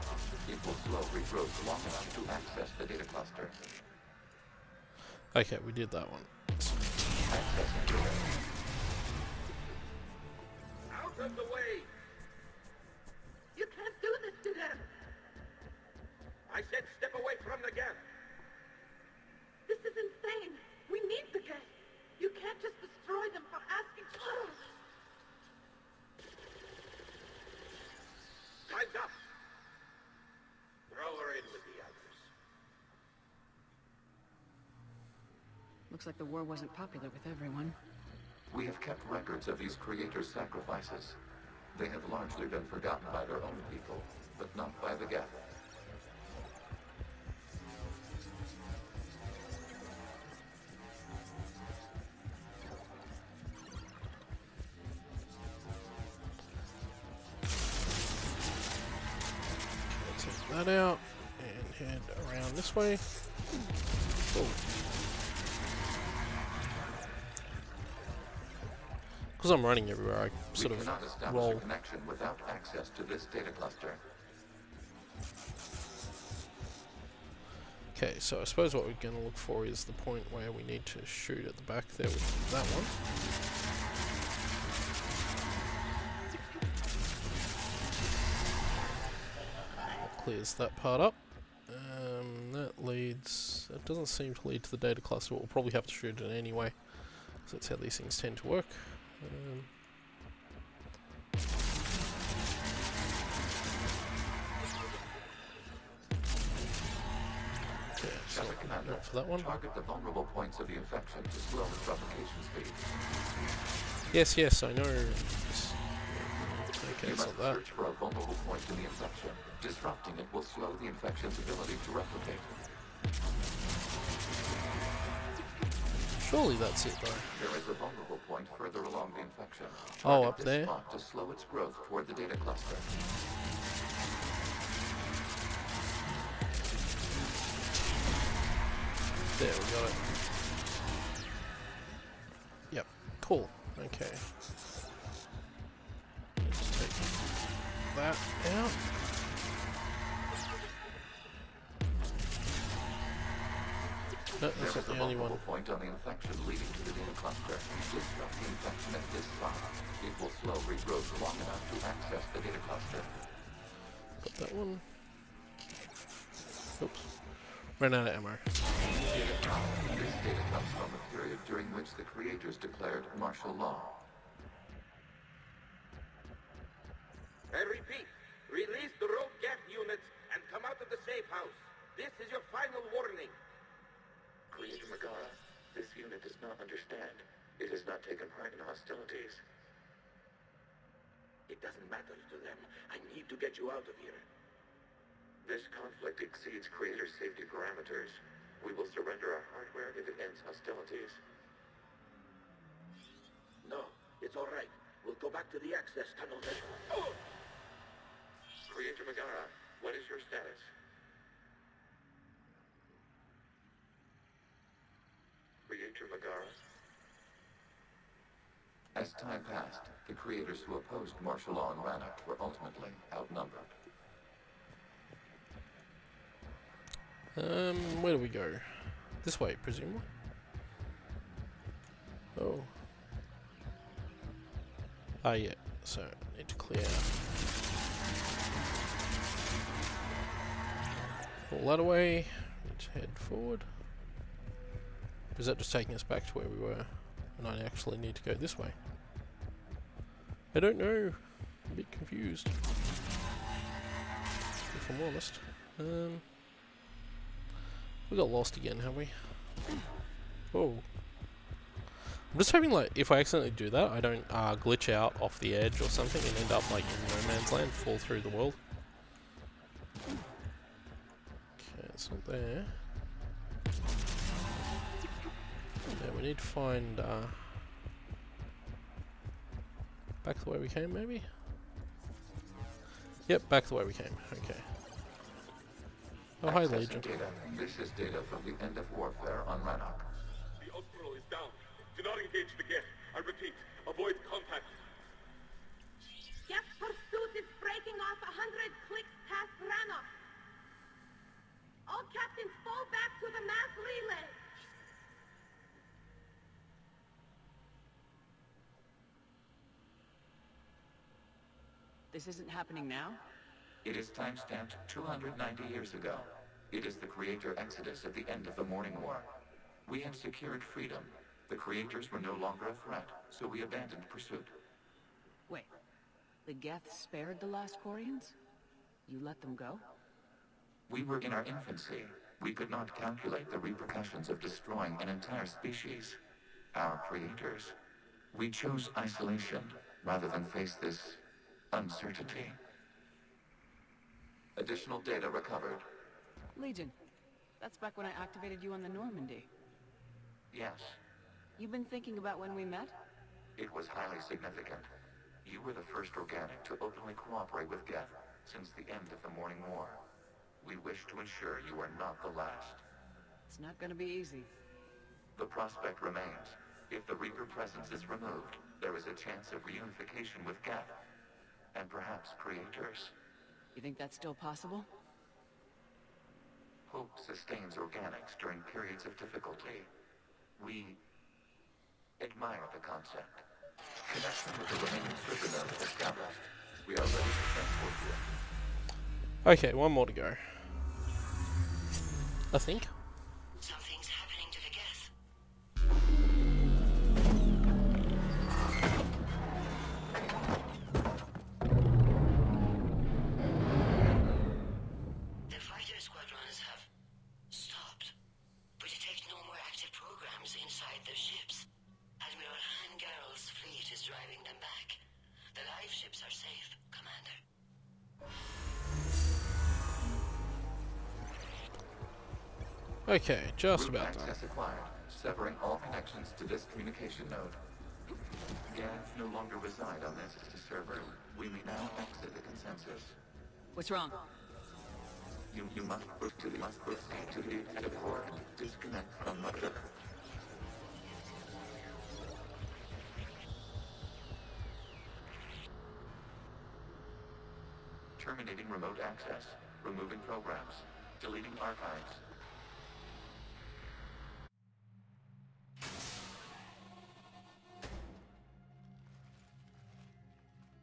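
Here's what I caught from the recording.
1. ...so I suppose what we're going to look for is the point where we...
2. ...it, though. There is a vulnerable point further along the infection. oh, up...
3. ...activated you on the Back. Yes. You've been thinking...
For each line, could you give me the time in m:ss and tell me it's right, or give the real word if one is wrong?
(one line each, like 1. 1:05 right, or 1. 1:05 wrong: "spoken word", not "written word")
1. 1:18 right
2. 2:06 right
3. 5:48 wrong: "Normandy", not "Back".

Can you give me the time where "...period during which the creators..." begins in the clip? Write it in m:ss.
2:51.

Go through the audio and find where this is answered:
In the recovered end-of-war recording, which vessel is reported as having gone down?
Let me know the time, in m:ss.
4:50.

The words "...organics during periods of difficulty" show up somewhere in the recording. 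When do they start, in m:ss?
6:17.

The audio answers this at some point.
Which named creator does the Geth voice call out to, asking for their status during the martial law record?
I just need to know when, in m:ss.
3:29.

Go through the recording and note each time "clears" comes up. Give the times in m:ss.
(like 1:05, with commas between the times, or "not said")
1:30, 3:56.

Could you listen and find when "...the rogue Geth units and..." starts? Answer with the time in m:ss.
2:59.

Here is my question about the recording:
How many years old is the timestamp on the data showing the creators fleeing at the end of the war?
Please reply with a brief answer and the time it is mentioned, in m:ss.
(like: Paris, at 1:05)
290, at 5:14.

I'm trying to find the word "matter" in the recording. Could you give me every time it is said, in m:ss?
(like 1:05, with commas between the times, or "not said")
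3:11.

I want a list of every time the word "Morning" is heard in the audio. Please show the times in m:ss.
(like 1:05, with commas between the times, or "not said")
5:18, 5:59.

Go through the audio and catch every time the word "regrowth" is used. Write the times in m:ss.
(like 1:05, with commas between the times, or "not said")
0:01, 2:40.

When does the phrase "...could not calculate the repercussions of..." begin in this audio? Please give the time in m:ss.
5:32.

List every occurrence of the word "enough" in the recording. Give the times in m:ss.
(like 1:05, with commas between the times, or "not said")
0:01, 2:41.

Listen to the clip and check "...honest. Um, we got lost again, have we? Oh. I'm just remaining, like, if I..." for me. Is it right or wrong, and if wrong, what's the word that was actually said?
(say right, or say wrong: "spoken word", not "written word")
wrong: "hoping", not "remaining".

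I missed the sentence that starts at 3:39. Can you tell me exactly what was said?
As time passed, the creators who opposed martial law and Rannoch were ultimately outnumbered.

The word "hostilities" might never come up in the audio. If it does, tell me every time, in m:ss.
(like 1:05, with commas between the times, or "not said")
3:08, 3:20.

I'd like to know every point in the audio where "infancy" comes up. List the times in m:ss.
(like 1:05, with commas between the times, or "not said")
5:31.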